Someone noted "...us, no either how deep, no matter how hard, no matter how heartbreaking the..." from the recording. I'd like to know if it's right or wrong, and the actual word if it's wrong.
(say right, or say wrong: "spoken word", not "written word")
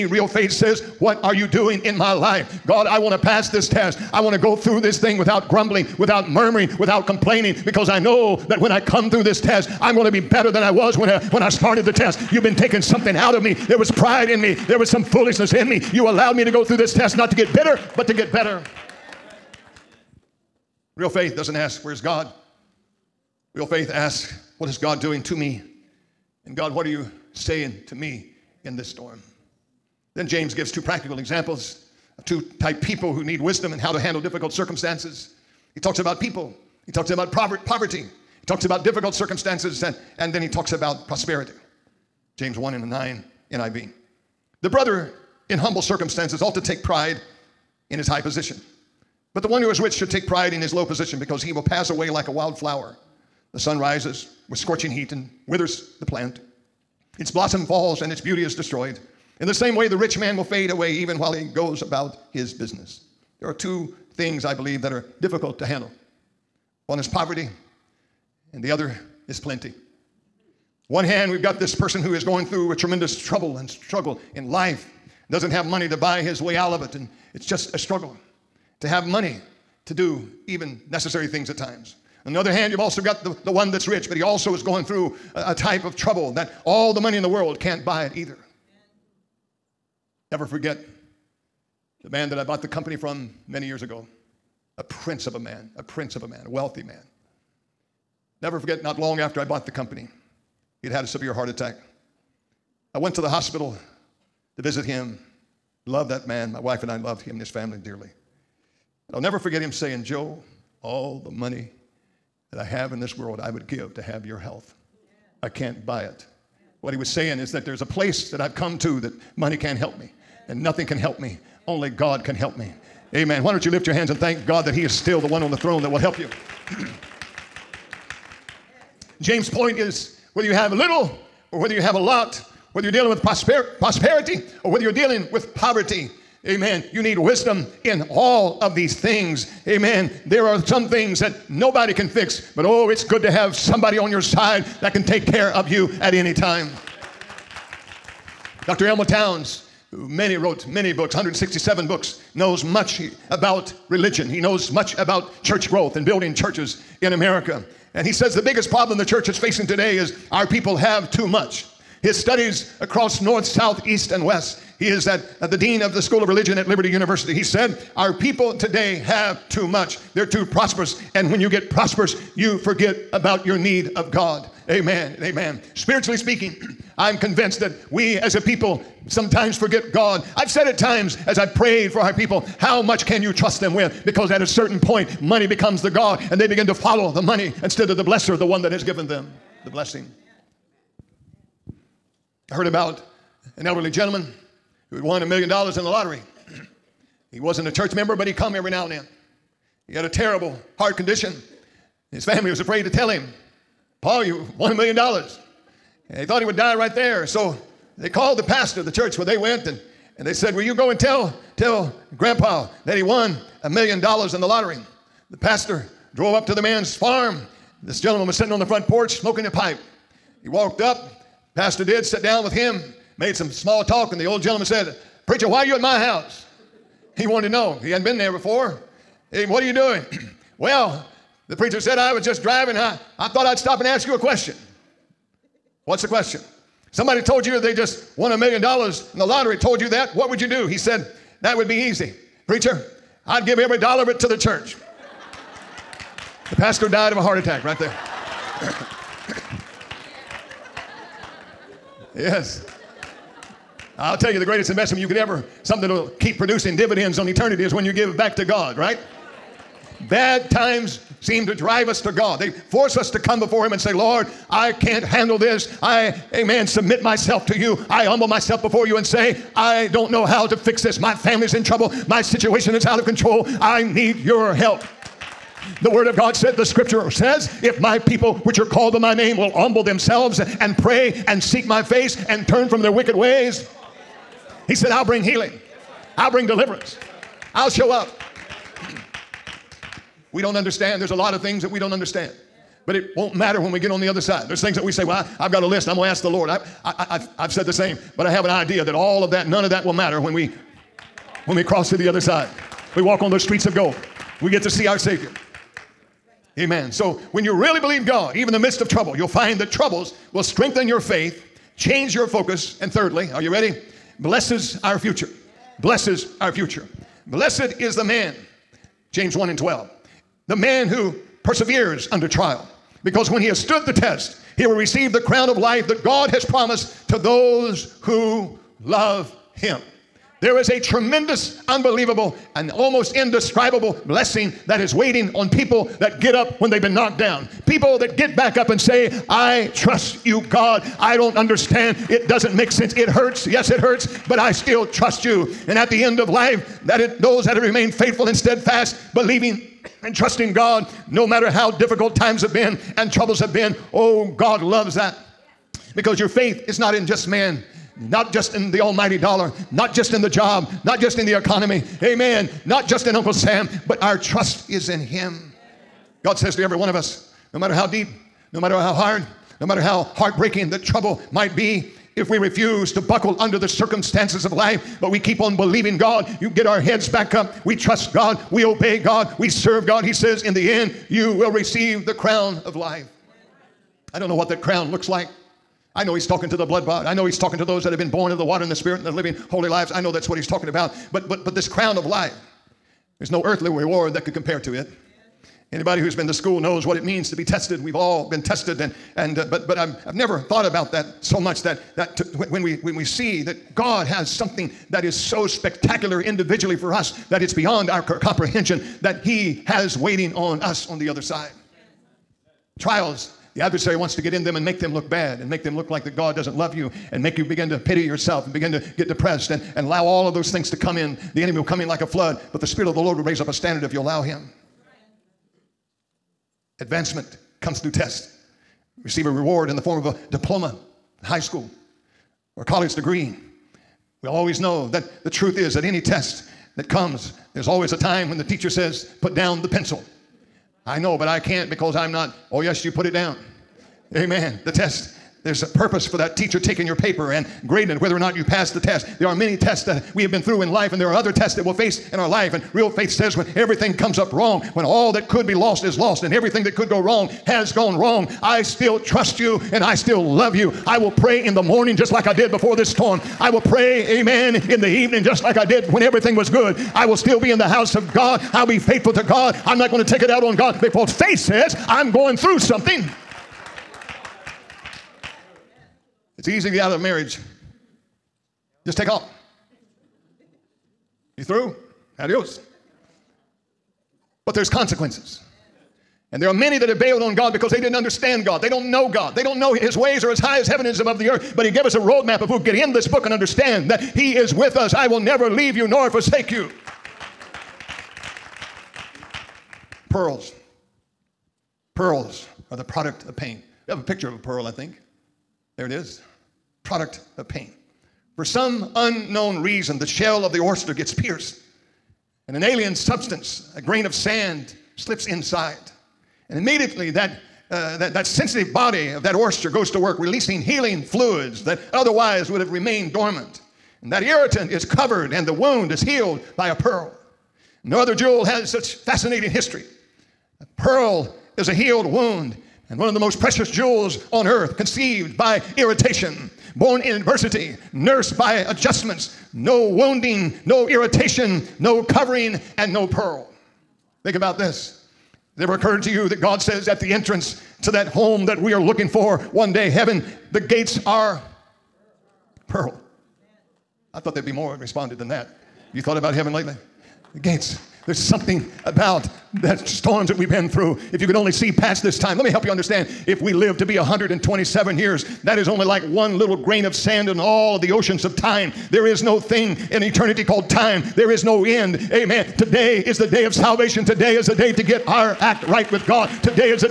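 wrong: "matter", not "either".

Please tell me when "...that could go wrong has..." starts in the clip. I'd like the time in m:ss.
7:36.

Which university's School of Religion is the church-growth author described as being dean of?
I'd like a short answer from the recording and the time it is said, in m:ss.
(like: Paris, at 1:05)
Liberty University, at 2:46.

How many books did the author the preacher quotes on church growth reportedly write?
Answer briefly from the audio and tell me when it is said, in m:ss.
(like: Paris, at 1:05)
167, at 2:31.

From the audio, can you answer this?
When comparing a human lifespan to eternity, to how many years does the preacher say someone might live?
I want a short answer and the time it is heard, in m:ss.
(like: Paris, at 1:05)
127, at 9:23.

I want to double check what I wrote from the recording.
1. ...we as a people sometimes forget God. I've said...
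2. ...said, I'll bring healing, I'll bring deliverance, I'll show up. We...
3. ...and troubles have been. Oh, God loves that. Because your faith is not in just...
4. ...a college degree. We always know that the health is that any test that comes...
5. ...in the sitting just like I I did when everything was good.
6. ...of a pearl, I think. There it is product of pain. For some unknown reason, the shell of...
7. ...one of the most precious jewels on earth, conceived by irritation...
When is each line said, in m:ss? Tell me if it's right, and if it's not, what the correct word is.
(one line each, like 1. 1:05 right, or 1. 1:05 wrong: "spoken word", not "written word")
1. 2:57 right
2. 4:44 right
3. 5:52 right
4. 7:12 wrong: "truth", not "health"
5. 7:44 wrong: "evening", not "sitting"
6. 8:24 right
7. 8:52 right.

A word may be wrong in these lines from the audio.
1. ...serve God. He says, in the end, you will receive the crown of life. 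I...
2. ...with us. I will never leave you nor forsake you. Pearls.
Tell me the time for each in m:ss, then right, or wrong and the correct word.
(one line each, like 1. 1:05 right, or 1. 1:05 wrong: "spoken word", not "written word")
1. 6:19 right
2. 8:14 right.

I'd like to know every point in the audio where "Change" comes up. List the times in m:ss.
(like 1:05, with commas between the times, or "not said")
5:11.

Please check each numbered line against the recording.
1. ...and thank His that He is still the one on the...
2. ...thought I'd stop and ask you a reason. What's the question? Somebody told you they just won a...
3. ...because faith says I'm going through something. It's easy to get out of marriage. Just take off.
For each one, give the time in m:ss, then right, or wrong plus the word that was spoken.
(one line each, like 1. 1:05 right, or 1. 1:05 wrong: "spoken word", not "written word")
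1. 2:04 wrong: "God", not "His"
2. 3:53 wrong: "question", not "reason"
3. 7:50 right.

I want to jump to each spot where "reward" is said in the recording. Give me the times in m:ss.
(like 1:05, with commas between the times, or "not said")
6:33, 7:09.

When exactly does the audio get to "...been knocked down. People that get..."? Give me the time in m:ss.
5:36.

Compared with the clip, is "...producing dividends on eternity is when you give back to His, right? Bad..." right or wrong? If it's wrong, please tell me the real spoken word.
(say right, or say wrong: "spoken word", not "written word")
wrong: "God", not "His".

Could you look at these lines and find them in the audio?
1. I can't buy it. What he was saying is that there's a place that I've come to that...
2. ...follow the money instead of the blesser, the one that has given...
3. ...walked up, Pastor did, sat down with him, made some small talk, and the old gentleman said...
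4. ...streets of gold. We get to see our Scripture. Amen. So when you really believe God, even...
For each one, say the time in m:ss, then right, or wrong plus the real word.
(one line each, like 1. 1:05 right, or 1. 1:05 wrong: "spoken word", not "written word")
1. 1:55 right
2. 3:06 right
3. 3:40 right
4. 5:03 wrong: "Savior", not "Scripture".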